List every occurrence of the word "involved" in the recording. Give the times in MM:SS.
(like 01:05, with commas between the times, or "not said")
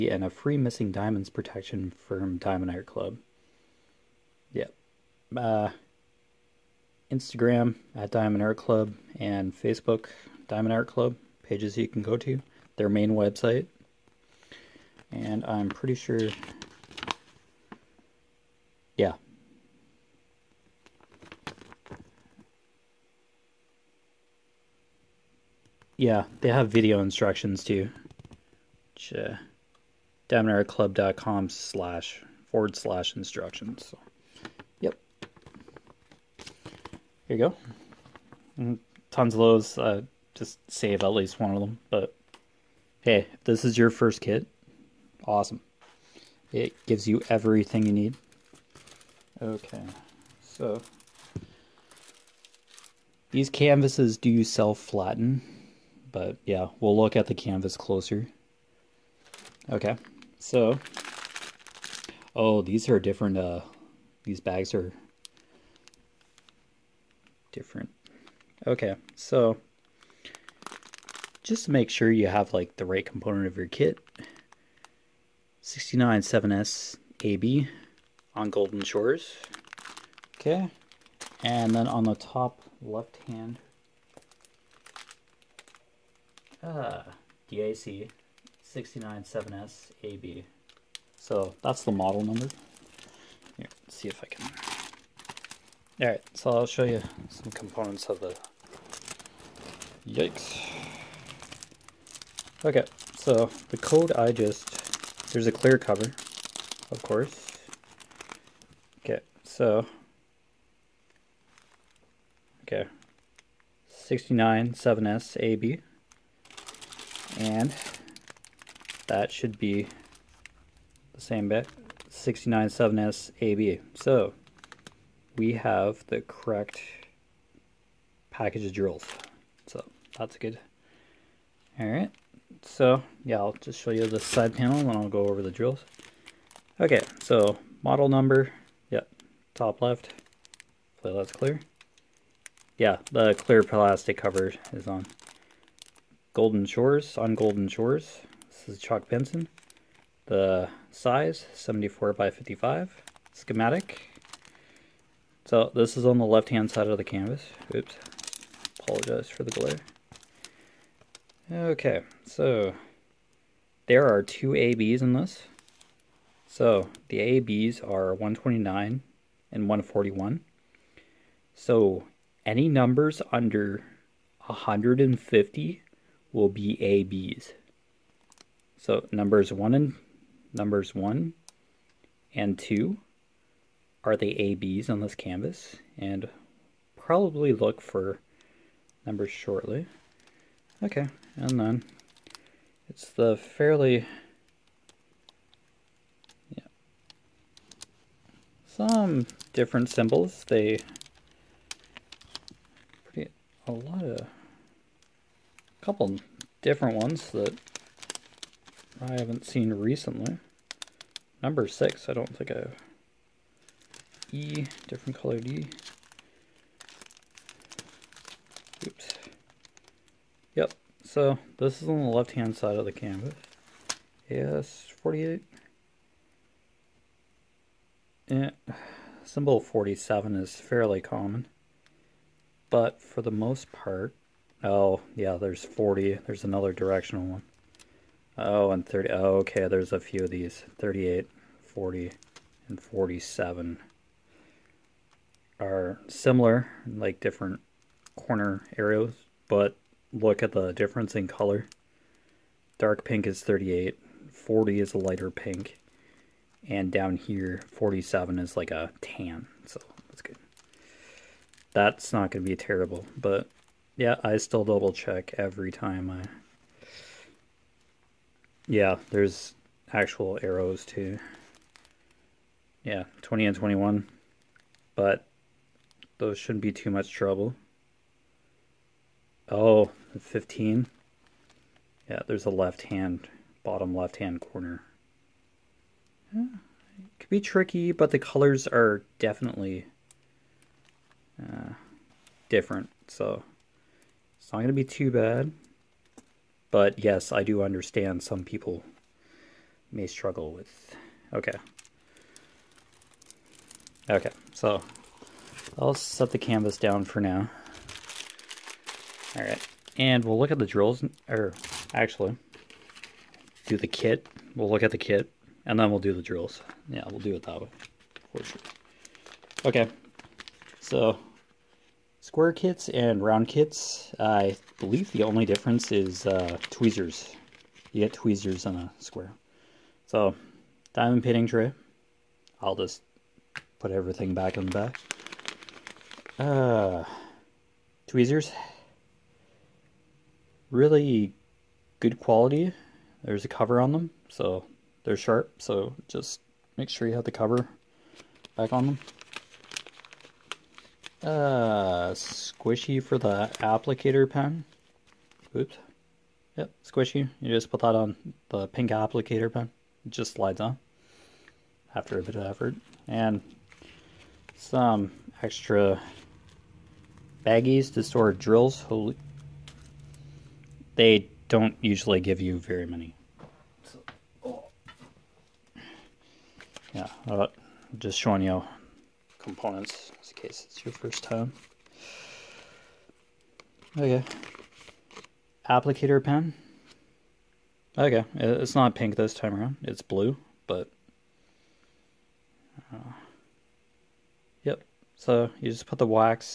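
not said.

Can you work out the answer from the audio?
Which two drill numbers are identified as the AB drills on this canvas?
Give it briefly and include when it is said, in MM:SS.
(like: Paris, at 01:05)
129 and 141, at 02:48.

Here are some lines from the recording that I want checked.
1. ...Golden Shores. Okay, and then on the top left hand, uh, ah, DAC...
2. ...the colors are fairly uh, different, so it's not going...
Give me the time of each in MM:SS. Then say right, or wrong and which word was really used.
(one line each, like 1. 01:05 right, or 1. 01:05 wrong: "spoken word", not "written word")
1. 01:18 right
2. 04:48 wrong: "definitely", not "fairly".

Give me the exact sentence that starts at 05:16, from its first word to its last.
Yeah, we'll do it that way, for sure.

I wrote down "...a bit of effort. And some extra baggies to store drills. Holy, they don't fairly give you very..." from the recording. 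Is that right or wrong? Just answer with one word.
wrong.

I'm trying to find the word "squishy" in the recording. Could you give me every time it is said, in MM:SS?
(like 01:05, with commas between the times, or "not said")
05:52, 05:56.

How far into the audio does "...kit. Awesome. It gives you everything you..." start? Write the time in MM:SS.
00:44.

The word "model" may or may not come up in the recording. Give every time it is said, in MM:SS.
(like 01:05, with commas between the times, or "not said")
01:31, 02:17.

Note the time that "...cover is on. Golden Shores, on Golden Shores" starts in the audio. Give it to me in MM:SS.
02:24.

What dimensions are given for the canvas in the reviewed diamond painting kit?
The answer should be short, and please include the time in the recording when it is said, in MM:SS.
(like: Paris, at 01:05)
74 by 55, at 02:31.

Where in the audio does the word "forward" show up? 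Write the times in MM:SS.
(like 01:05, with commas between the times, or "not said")
00:32.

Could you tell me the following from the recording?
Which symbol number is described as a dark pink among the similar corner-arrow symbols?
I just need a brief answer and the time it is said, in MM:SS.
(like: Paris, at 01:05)
38, at 04:12.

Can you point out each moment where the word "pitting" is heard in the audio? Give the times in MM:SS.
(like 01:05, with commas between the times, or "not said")
05:31.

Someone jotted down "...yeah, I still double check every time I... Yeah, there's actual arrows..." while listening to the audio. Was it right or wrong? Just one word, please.
right.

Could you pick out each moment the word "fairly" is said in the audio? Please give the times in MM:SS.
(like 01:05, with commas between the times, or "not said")
03:13, 03:50.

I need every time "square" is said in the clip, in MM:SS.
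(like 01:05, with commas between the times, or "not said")
05:22, 05:28.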